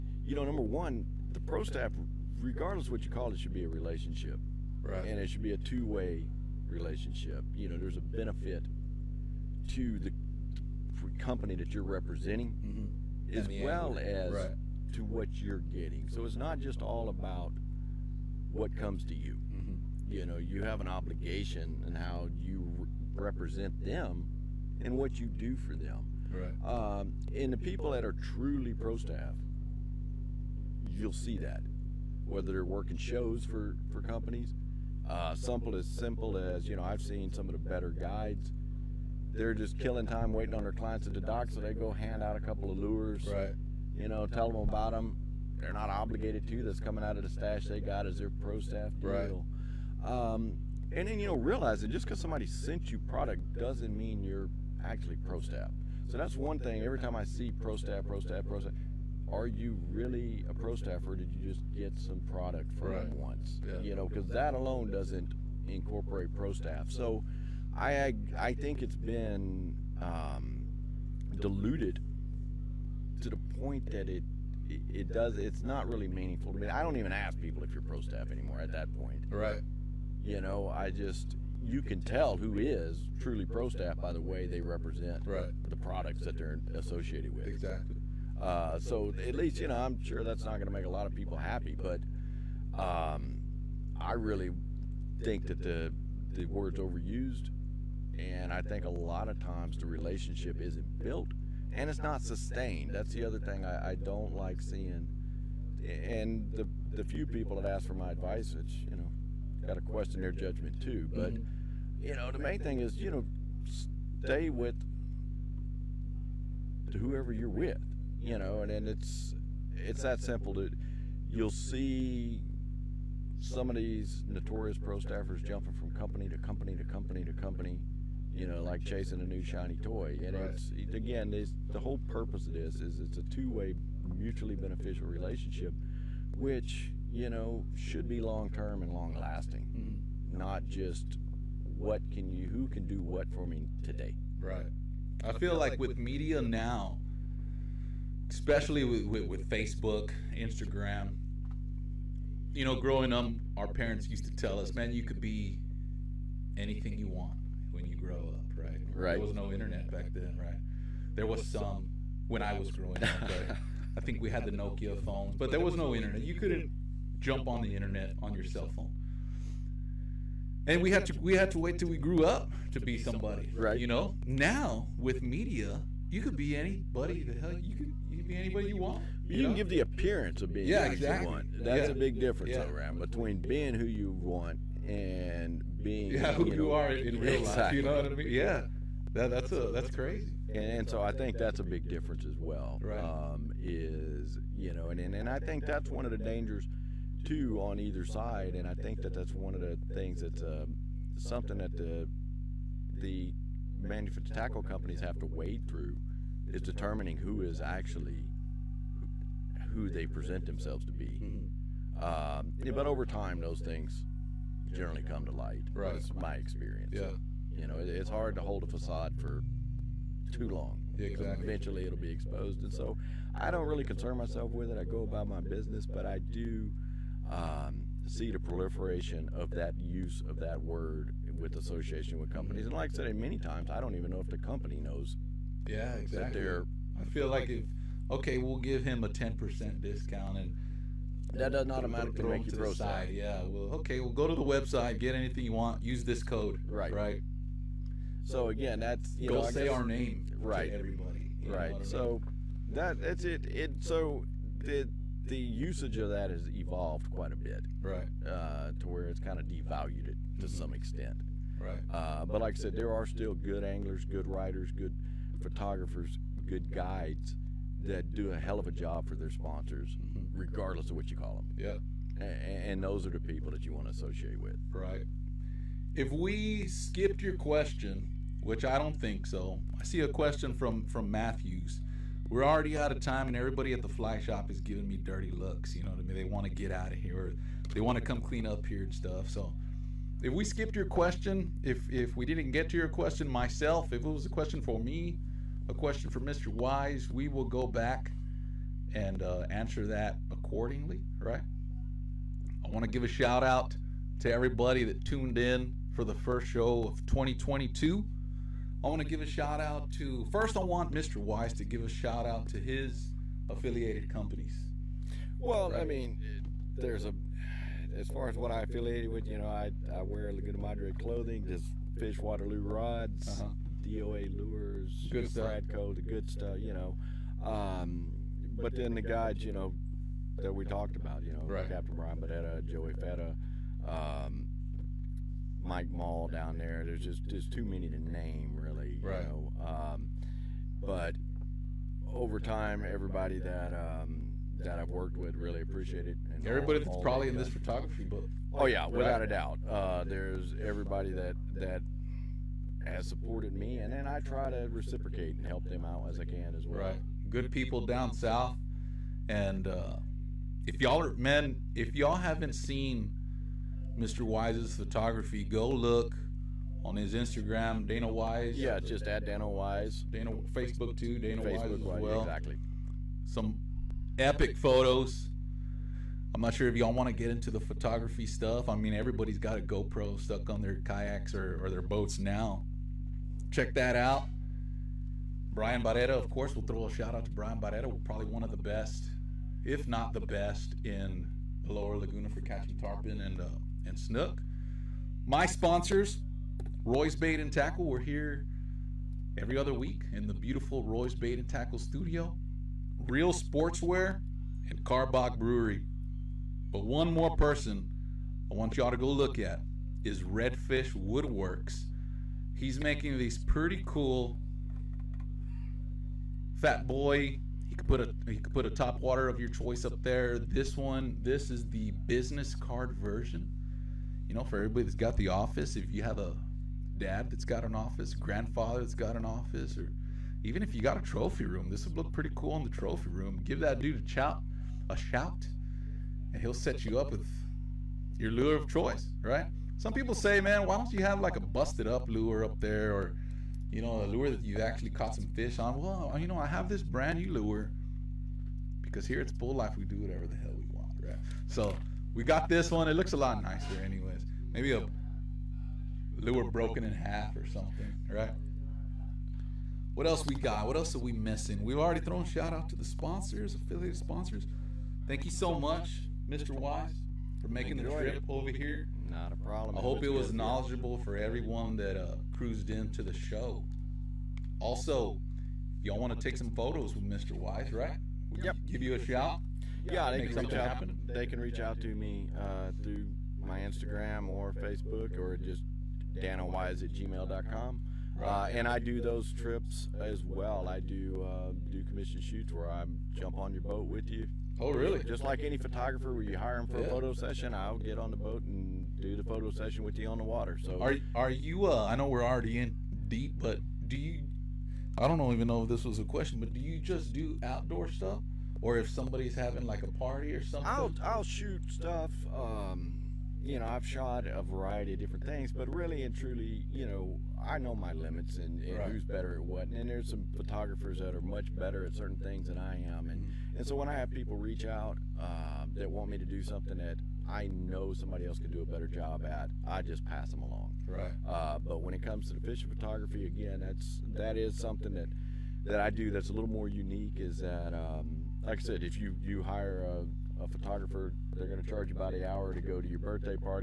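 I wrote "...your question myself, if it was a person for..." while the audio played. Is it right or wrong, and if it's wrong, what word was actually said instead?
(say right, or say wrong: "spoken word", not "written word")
wrong: "question", not "person".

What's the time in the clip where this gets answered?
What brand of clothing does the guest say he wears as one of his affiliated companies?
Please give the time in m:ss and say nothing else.
5:20.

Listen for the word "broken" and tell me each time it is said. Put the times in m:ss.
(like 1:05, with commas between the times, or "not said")
7:36.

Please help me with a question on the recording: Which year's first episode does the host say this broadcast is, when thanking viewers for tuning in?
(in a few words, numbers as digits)
2022.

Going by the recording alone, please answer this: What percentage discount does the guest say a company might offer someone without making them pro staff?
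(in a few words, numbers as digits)
10 percent.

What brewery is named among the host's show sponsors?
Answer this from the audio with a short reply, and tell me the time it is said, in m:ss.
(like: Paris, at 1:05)
Karbach Brewery, at 6:44.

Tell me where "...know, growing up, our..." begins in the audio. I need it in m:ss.
2:32.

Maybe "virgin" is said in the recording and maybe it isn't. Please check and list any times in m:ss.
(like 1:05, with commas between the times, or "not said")
not said.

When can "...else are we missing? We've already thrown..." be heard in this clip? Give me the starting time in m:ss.
7:40.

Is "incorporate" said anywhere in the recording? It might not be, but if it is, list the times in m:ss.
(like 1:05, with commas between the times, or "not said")
1:05.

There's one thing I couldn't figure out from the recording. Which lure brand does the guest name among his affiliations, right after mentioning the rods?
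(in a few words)
DOA.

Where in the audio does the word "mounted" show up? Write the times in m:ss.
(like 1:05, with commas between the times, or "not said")
not said.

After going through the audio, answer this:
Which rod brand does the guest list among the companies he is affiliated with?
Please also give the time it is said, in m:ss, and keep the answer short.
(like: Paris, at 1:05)
Waterloo, at 5:22.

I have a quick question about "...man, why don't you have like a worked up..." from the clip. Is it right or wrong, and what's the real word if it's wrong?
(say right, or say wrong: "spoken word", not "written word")
wrong: "busted", not "worked".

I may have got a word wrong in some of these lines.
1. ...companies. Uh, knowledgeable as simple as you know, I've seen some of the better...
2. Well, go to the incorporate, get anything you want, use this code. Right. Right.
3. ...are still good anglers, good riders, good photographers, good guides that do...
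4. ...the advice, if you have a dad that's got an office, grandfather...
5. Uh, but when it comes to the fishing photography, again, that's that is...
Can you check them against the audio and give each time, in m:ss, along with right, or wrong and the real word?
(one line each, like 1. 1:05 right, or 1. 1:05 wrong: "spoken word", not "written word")
1. 0:34 wrong: "simple", not "knowledgeable"
2. 4:03 wrong: "website", not "incorporate"
3. 4:22 right
4. 7:05 wrong: "office", not "advice"
5. 8:51 right.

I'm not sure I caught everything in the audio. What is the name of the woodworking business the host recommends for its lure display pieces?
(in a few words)
Redfish Woodworks.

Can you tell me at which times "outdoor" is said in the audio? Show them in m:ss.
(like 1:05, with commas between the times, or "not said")
8:27.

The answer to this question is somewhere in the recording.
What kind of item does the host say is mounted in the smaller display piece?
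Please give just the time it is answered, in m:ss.
7:02.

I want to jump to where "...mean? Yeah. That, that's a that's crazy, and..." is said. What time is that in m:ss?
3:08.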